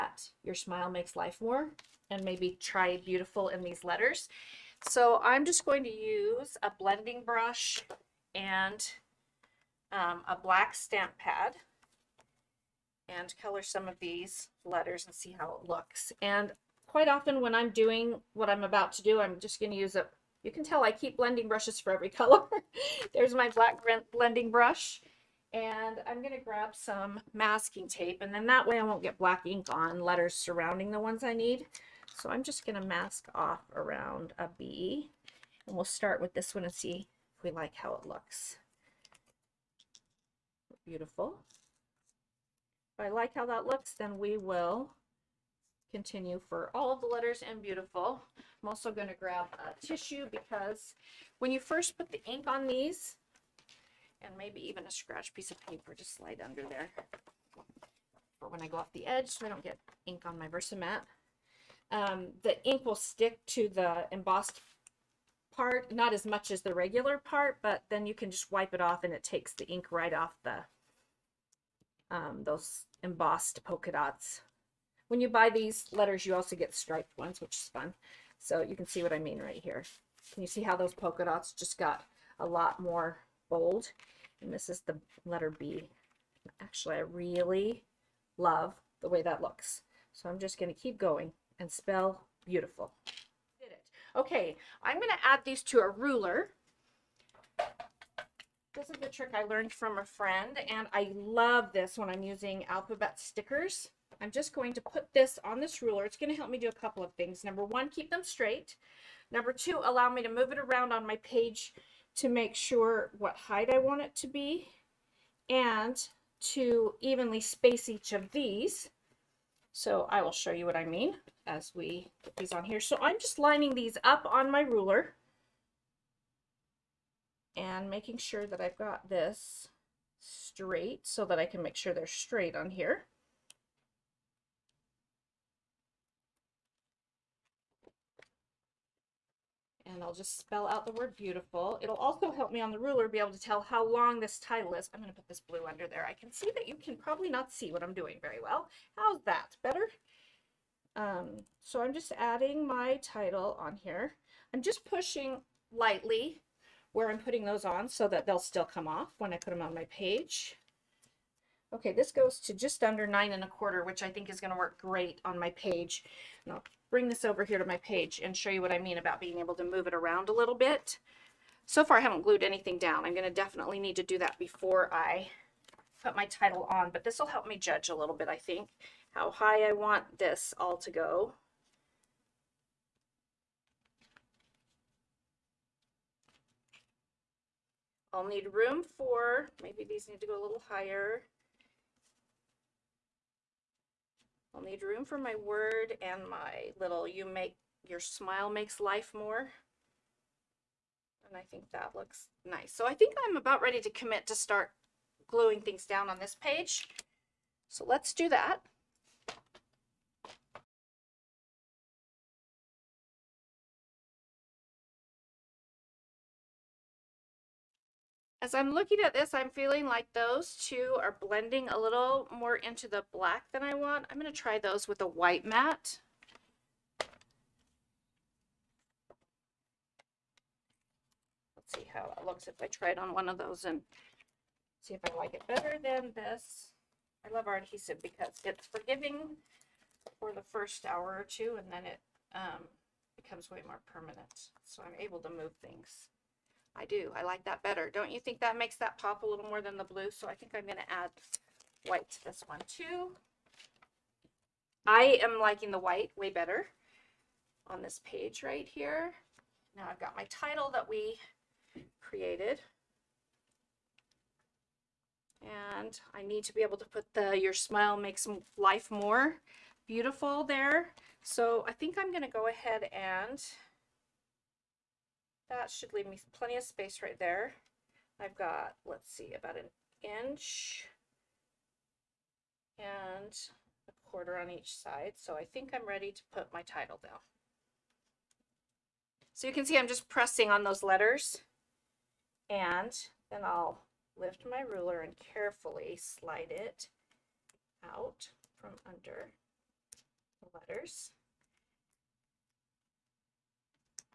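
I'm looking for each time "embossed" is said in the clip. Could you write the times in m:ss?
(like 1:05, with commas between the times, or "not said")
1:04, 1:13.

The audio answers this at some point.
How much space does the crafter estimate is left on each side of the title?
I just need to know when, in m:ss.
4:39.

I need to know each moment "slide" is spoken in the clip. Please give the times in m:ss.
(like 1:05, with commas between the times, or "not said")
0:56, 4:55.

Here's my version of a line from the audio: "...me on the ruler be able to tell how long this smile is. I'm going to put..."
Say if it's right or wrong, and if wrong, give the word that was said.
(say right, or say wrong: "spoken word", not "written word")
wrong: "title", not "smile".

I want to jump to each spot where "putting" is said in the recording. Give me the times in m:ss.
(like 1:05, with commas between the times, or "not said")
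2:37.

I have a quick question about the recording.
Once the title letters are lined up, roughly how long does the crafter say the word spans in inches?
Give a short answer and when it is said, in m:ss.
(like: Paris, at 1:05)
just under 9 1/4, at 2:42.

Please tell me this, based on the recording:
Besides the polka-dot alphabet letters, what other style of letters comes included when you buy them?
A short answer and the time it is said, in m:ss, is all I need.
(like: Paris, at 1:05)
striped ones, at 1:16.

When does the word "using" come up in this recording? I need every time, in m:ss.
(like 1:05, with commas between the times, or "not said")
1:42.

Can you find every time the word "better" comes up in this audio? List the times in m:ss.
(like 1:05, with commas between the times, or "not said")
2:29, 3:55, 4:07, 4:16.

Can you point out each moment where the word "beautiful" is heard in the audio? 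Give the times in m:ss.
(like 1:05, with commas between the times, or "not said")
0:02, 0:40, 0:47, 1:32, 2:21, 4:29.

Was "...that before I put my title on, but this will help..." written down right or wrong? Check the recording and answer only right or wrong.
right.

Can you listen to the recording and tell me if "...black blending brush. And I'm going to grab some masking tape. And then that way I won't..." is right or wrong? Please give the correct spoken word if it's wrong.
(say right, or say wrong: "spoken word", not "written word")
right.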